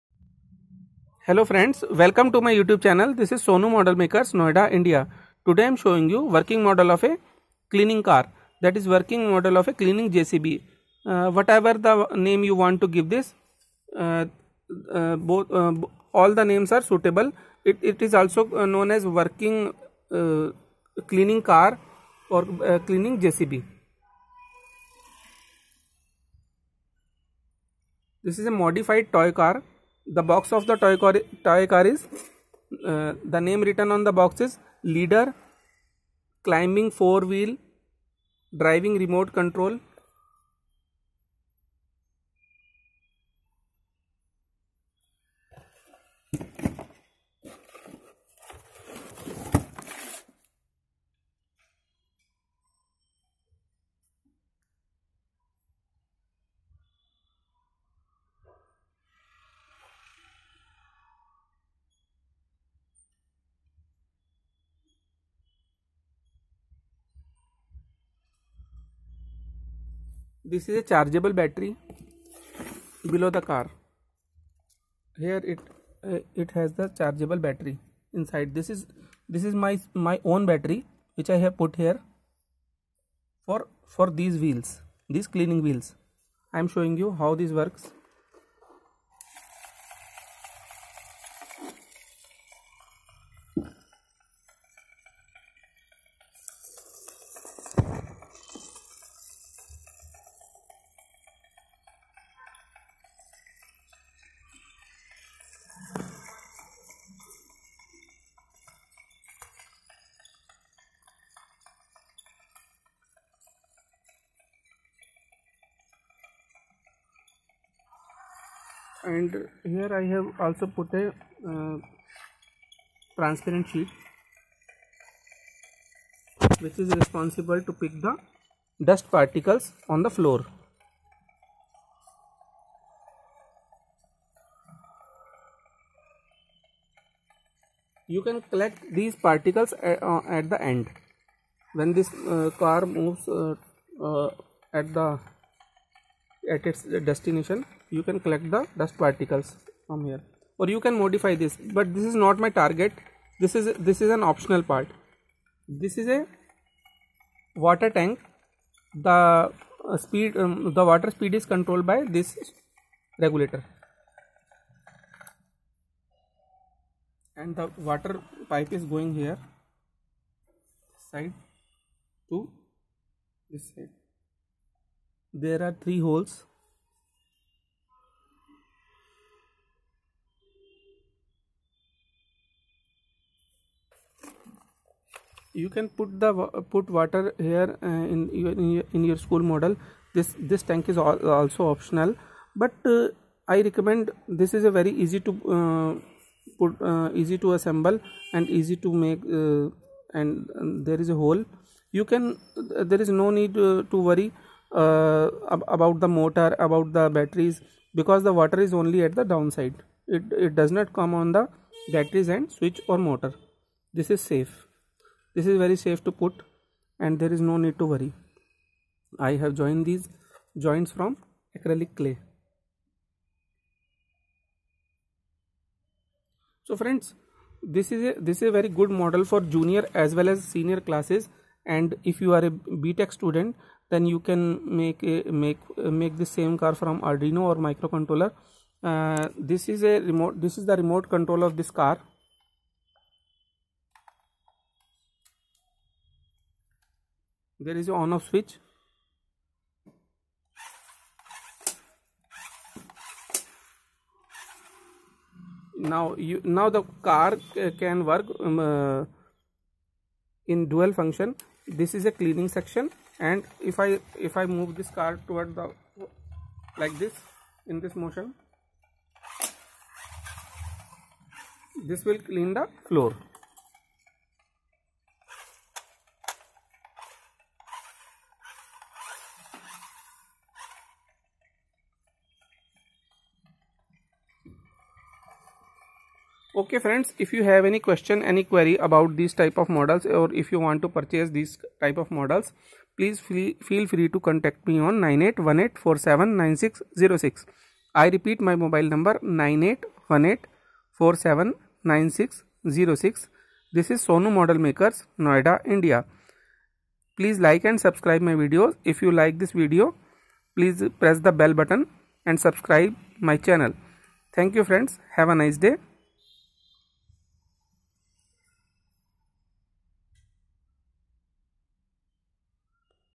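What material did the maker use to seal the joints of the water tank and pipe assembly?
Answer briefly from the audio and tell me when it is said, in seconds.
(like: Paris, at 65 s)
acrylic clay, at 221 s.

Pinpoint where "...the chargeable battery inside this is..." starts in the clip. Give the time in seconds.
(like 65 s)
76 s.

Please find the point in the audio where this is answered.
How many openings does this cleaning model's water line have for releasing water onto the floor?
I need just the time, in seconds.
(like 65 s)
175 s.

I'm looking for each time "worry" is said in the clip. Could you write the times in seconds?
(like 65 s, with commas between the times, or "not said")
204 s, 217 s.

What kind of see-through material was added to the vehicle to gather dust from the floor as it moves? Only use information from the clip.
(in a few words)
transparent sheet.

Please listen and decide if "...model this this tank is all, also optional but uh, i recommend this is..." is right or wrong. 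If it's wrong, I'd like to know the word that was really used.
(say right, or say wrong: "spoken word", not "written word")
right.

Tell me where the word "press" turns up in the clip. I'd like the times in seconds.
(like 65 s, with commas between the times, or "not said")
310 s.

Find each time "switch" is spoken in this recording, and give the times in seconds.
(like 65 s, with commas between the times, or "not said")
212 s, 248 s.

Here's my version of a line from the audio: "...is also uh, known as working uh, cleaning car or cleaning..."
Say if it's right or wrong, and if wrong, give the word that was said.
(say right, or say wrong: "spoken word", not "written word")
right.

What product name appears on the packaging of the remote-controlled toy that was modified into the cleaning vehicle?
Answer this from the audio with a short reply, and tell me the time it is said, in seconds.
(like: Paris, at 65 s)
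leader climbing four wheel driving, at 34 s.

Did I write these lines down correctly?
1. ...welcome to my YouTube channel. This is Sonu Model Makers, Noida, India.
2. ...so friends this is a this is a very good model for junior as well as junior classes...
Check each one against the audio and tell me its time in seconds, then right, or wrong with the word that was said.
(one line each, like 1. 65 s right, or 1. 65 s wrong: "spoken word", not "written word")
1. 1 s right
2. 226 s wrong: "senior", not "junior".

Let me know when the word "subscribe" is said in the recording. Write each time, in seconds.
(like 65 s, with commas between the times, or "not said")
307 s, 312 s.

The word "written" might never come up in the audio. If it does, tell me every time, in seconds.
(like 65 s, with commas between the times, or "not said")
33 s.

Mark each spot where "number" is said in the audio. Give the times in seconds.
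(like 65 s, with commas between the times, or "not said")
298 s.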